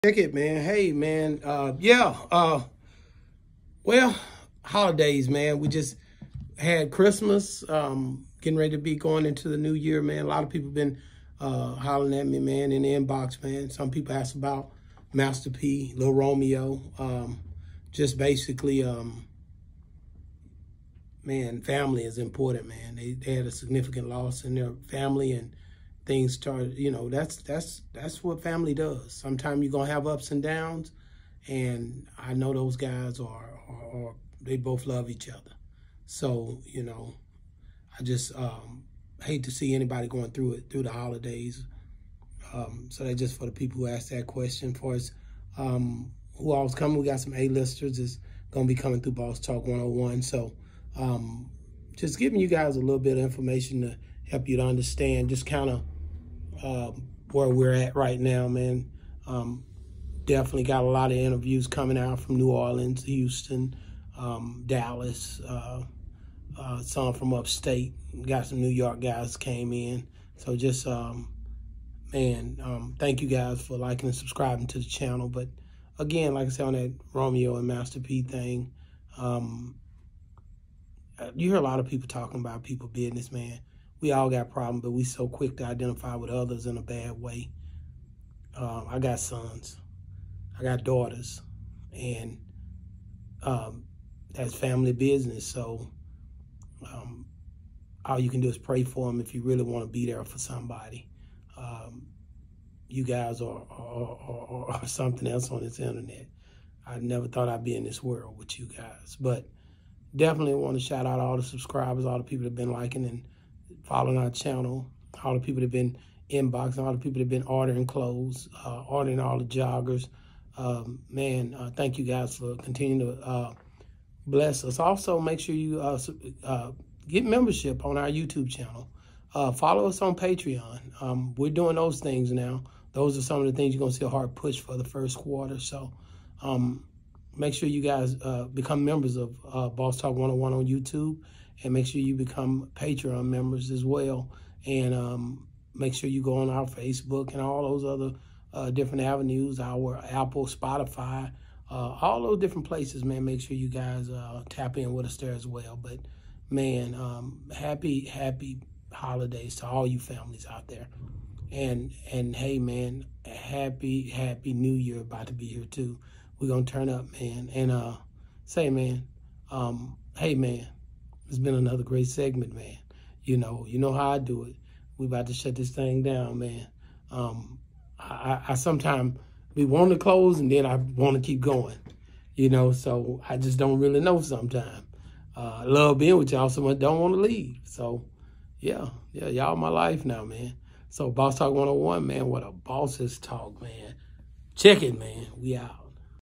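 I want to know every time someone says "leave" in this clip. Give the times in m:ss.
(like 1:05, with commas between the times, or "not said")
3:07.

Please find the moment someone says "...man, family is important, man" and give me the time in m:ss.
0:21.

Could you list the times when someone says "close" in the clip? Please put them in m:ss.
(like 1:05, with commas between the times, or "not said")
2:59.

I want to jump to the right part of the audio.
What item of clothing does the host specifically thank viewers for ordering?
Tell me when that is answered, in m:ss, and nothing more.
1:59.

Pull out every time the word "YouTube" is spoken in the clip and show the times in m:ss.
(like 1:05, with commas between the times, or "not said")
2:08, 2:20.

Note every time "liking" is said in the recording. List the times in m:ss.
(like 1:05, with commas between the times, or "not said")
1:13, 1:52.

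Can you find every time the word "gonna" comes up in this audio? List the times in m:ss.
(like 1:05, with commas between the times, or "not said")
0:29, 0:48, 2:46.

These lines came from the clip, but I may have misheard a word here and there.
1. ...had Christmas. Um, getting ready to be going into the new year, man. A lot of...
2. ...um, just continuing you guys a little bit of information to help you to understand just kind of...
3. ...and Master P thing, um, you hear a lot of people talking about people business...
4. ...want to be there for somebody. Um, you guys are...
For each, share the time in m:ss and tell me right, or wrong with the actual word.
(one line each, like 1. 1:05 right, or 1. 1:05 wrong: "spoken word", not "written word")
1. 0:06 right
2. 0:50 wrong: "giving", not "continuing"
3. 1:17 right
4. 1:39 right.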